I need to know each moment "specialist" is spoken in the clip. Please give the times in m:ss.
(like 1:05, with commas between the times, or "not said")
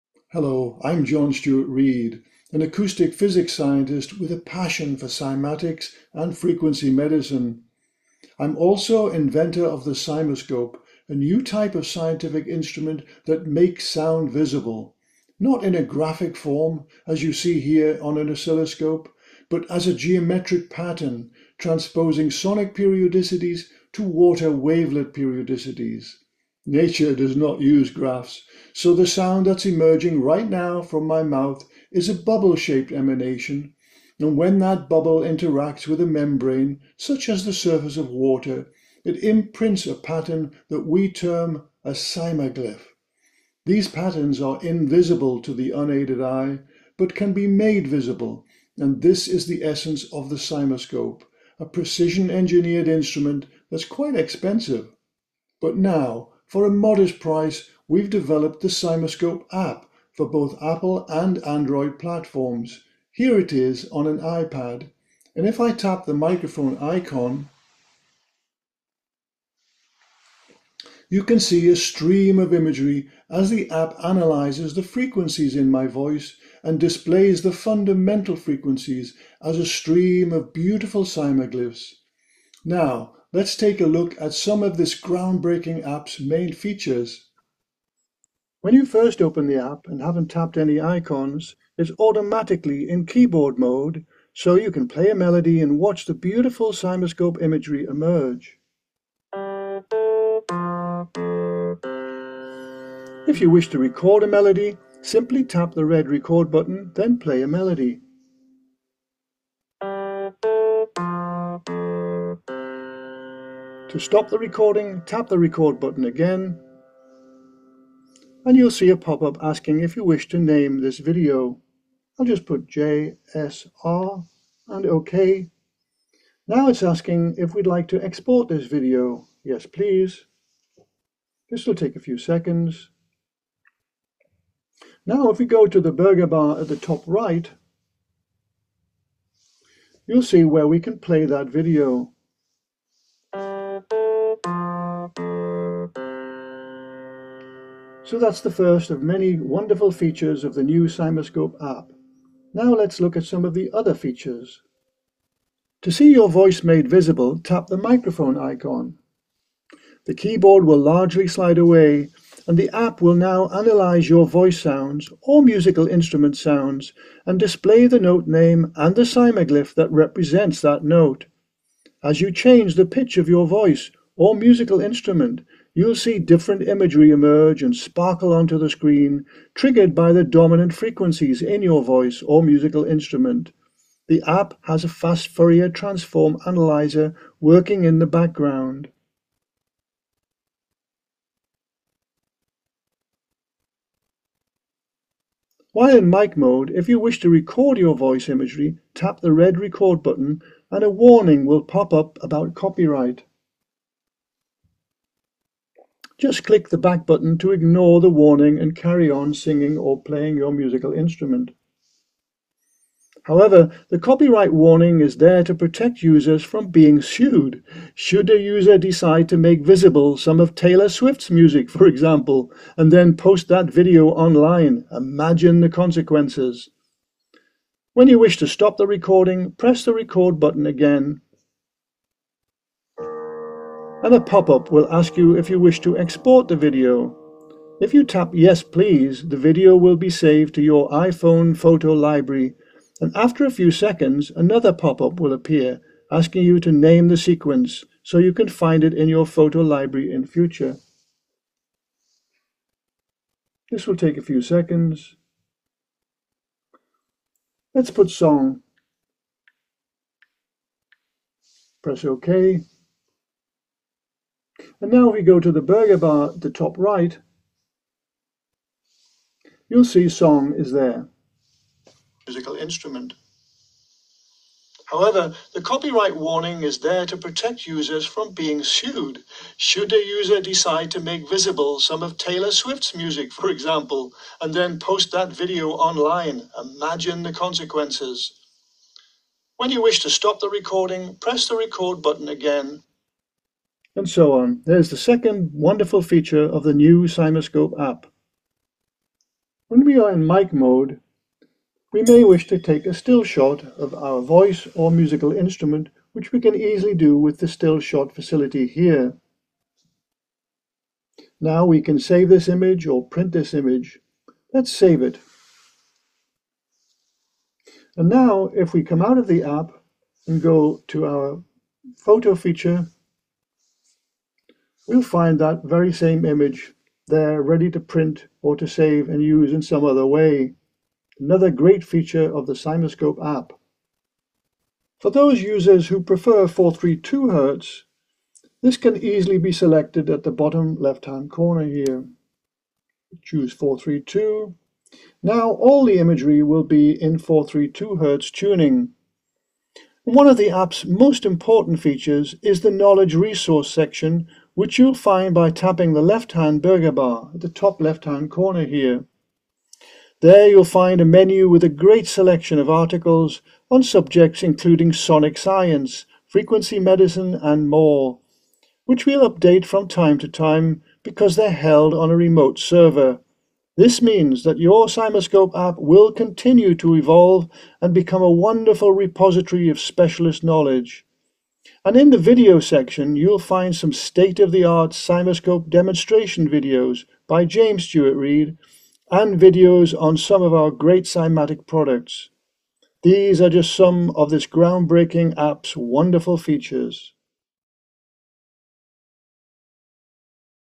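6:19.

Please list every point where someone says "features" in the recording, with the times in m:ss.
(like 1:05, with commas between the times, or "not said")
1:26, 2:29, 2:33, 4:56, 5:22, 5:31, 5:51, 6:36.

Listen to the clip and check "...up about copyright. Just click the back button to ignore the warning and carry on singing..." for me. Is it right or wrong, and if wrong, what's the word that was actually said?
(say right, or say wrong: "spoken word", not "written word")
right.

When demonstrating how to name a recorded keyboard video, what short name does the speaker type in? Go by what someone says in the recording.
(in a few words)
JSR.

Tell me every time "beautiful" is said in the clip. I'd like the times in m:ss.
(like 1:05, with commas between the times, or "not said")
1:20, 1:36.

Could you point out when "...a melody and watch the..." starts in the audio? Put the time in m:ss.
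1:35.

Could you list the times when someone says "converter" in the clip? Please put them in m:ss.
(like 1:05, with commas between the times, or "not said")
not said.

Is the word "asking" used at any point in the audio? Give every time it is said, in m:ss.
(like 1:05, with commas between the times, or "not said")
1:59, 2:06, 4:06.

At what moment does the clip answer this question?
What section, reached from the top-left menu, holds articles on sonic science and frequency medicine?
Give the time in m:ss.
5:52.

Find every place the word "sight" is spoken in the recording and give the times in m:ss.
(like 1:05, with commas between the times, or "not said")
not said.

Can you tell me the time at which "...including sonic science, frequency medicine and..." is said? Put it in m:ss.
6:04.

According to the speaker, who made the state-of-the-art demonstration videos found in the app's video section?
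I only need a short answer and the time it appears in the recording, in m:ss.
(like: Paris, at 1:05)
James Stuart Reid, at 6:27.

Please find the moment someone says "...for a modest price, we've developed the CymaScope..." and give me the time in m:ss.
0:56.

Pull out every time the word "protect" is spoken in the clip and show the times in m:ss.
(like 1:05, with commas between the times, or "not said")
3:35, 4:37.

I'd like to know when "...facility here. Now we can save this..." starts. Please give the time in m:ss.
5:08.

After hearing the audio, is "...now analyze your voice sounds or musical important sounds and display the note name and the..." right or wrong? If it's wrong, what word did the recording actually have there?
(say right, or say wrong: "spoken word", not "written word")
wrong: "instrument", not "important".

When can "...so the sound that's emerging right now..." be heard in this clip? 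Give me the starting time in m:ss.
0:28.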